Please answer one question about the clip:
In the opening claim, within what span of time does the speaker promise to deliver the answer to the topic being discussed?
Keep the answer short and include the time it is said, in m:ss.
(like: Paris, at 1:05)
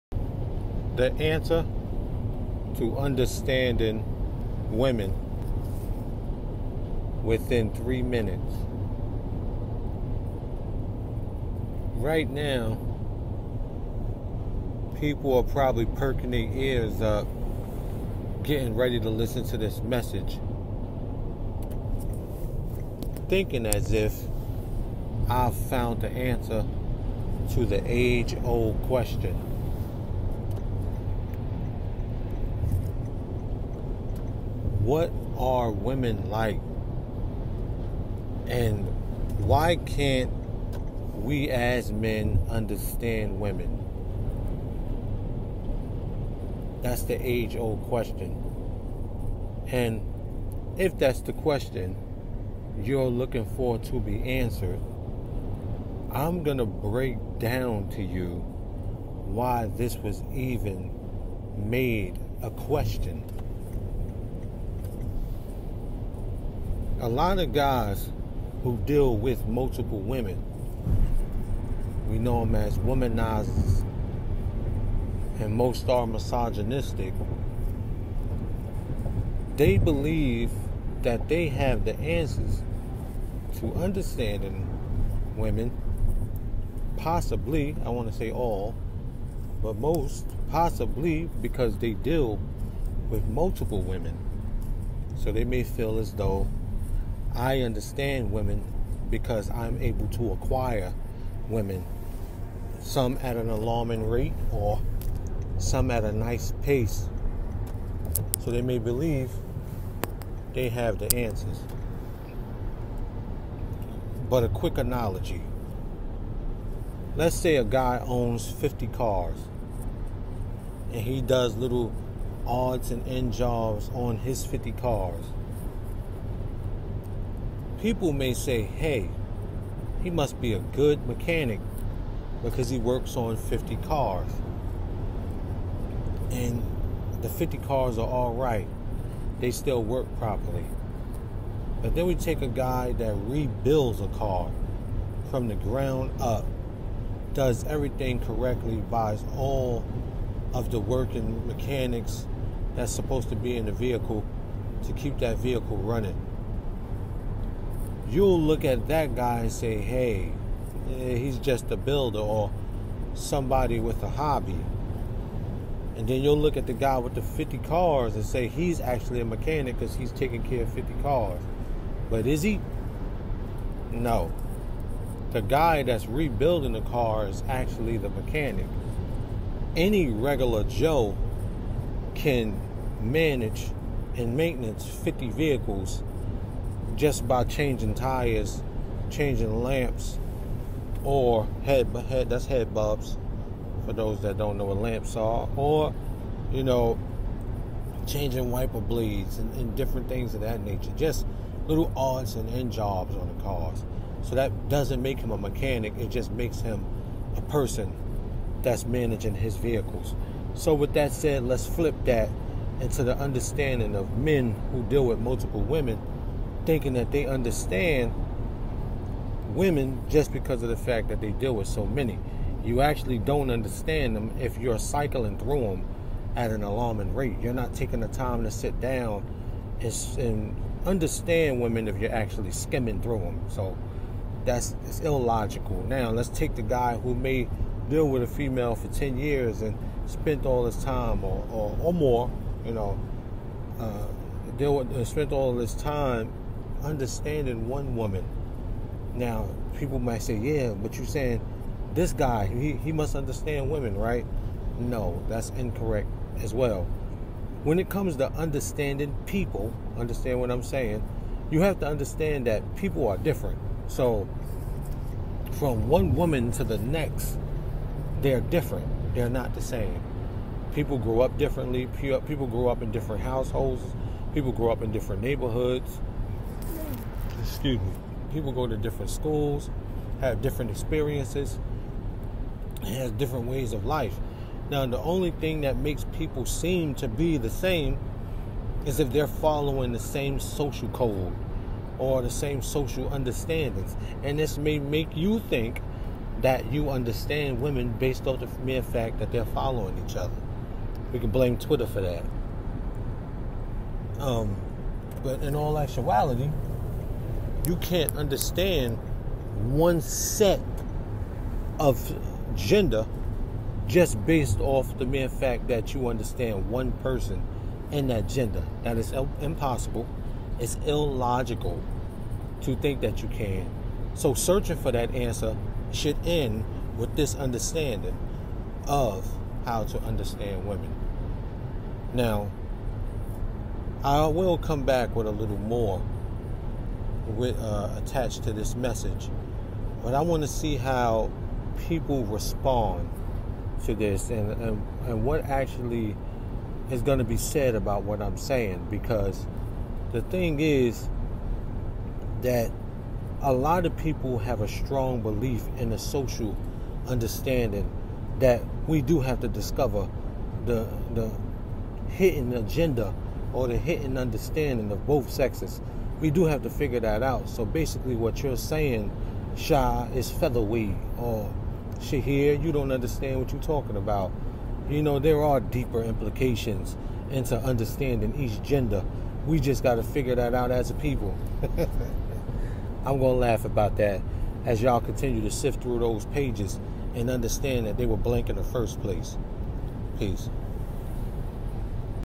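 3 minutes, at 0:07.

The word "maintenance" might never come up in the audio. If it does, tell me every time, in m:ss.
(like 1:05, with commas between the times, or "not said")
3:04.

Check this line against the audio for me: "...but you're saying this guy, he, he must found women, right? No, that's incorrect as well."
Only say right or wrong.
wrong.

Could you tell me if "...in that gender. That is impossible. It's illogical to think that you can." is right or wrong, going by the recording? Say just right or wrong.
right.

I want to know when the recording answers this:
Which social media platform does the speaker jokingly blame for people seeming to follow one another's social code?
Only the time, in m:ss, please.
5:01.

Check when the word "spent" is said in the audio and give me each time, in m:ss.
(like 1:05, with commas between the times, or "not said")
4:00, 4:05.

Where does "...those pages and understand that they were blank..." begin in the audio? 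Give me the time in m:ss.
6:25.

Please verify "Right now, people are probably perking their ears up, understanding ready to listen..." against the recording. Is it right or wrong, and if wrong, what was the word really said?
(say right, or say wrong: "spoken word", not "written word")
wrong: "getting", not "understanding".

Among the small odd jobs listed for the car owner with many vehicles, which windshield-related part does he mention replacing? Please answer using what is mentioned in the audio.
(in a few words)
wiper blades.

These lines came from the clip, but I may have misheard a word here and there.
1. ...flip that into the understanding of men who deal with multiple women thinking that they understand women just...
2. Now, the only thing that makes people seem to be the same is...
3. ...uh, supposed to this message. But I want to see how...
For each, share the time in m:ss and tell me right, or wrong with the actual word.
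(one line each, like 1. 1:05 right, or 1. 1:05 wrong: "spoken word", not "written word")
1. 3:31 right
2. 4:44 right
3. 5:37 wrong: "attached", not "supposed".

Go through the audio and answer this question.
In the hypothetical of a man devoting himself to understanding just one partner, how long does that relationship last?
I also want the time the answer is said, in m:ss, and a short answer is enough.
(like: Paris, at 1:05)
10 years, at 3:58.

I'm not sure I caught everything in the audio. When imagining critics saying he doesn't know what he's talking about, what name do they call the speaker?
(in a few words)
Shahir.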